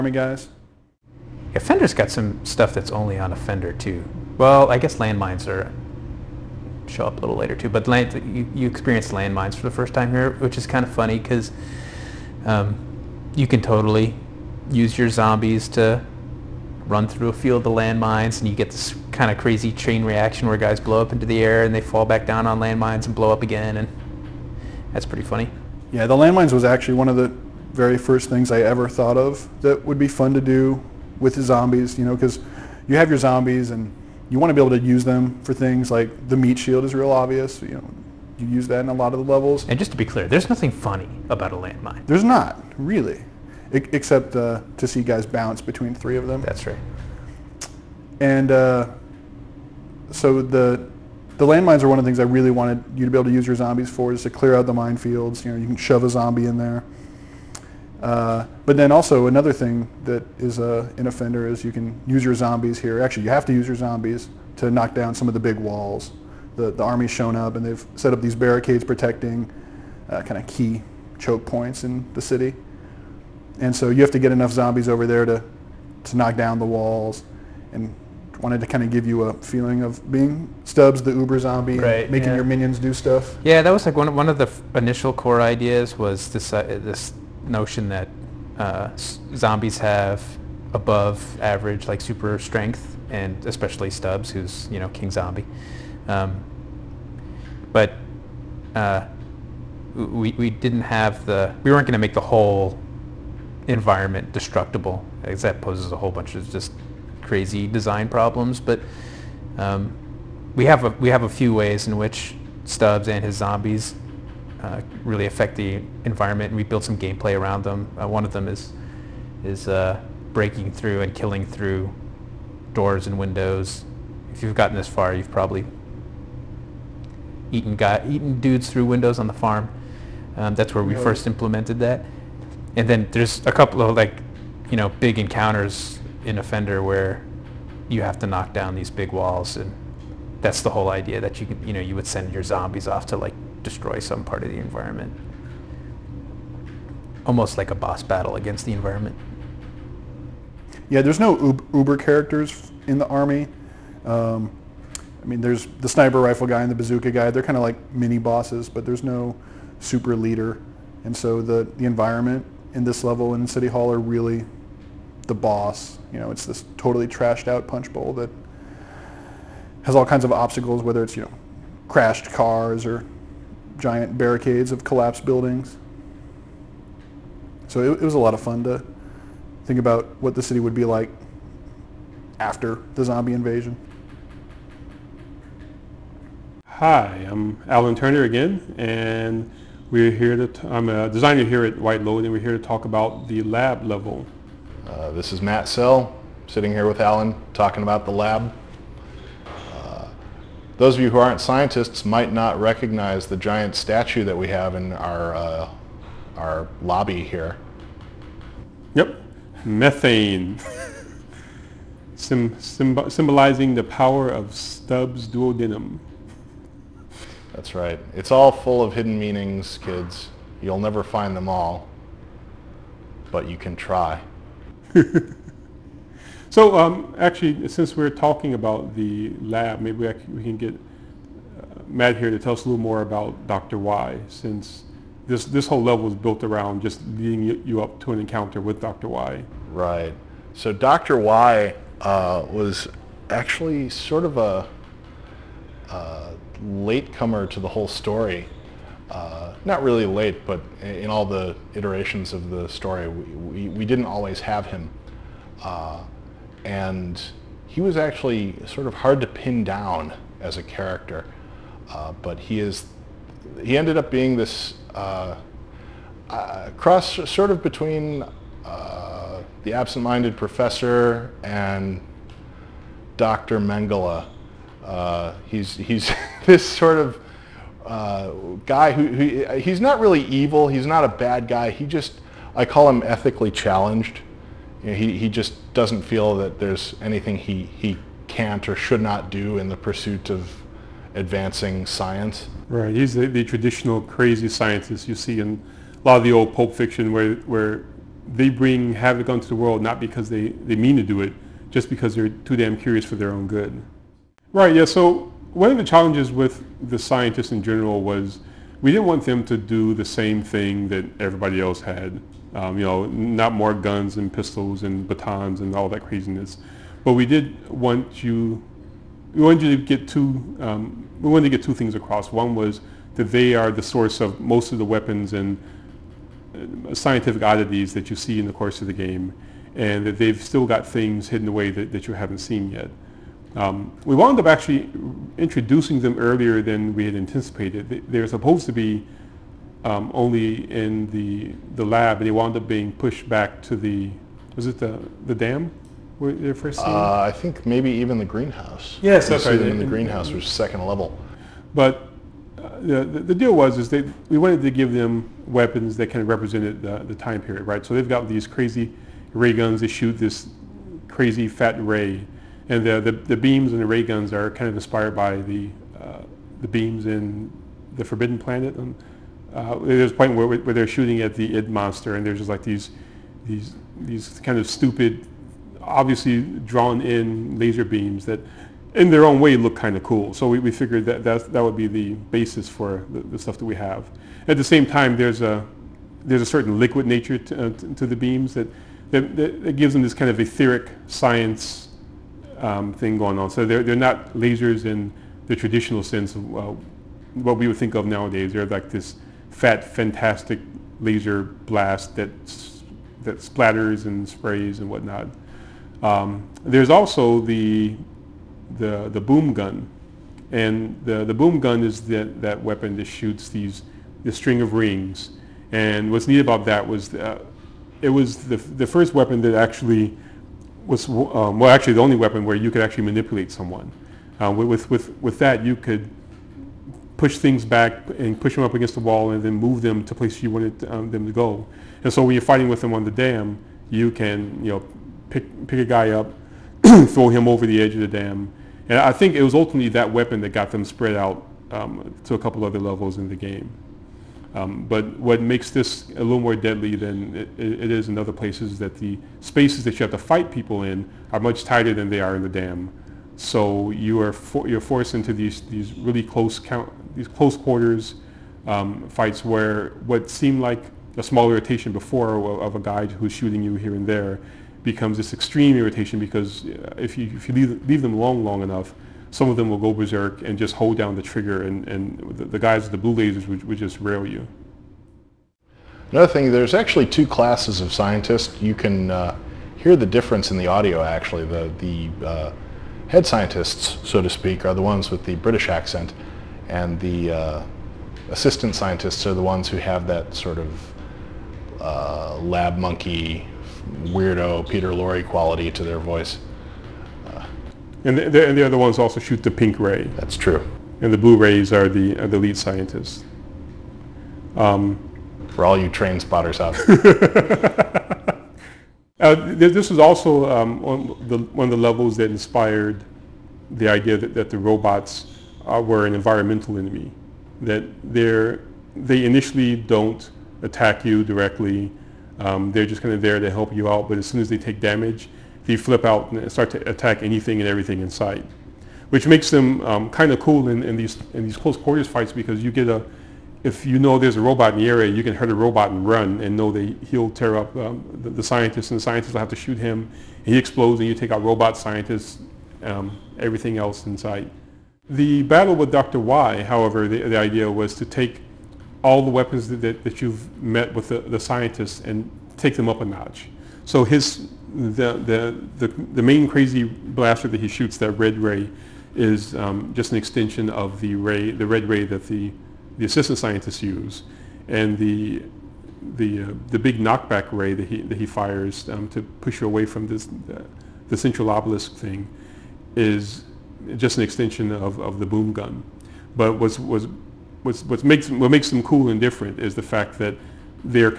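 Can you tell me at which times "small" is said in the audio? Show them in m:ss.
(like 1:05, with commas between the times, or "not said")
7:41.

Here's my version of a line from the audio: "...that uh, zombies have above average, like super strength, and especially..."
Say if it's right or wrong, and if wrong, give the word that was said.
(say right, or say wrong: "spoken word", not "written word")
right.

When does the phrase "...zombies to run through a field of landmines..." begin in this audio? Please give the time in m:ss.
0:15.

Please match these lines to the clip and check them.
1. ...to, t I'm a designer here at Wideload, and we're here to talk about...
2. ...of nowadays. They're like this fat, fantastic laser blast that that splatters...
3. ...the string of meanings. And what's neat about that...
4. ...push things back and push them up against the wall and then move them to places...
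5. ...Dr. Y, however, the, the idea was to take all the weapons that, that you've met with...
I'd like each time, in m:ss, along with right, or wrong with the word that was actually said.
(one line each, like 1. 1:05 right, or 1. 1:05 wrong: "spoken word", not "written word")
1. 3:10 right
2. 6:37 right
3. 6:54 wrong: "rings", not "meanings"
4. 7:07 right
5. 9:05 right.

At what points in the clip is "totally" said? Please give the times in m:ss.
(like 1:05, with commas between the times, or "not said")
0:13, 2:46.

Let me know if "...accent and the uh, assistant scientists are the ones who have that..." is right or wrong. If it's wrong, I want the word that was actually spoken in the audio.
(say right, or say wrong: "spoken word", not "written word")
right.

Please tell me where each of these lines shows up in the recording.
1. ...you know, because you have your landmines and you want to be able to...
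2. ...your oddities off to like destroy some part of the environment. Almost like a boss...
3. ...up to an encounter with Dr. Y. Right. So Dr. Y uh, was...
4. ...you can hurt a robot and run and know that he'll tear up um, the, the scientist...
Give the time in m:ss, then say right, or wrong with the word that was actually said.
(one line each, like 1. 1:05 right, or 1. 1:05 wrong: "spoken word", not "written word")
1. 0:31 wrong: "zombies", not "landmines"
2. 2:22 wrong: "zombies", not "oddities"
3. 3:57 right
4. 8:55 right.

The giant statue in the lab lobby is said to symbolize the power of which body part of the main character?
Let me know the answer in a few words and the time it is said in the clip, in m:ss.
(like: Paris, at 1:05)
duodenum, at 3:35.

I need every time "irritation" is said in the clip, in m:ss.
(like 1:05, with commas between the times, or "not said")
7:41, 7:45.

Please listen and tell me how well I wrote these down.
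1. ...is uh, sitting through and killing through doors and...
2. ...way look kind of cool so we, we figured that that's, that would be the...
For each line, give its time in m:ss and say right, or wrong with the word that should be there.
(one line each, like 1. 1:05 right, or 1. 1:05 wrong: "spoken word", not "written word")
1. 1:59 wrong: "breaking", not "sitting"
2. 6:19 right.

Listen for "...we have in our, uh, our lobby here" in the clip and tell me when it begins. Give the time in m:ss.
3:24.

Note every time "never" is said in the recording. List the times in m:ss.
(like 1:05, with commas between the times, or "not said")
3:40.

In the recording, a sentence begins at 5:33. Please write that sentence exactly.
Um, we wound up actually introducing them earlier than we had anticipated.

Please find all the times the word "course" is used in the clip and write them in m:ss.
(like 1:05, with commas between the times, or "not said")
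5:28.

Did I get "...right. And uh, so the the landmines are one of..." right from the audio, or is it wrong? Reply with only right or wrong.
right.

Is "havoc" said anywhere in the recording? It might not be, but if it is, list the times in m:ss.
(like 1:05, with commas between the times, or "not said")
4:58.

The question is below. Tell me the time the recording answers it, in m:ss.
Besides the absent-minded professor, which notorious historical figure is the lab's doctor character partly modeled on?
4:33.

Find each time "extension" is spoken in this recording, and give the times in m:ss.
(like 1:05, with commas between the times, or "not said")
9:20, 9:34.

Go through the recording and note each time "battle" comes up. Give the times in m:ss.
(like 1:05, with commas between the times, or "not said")
2:28, 9:05.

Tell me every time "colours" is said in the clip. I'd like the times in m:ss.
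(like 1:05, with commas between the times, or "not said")
not said.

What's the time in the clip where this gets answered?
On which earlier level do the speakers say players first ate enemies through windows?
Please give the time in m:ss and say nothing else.
2:09.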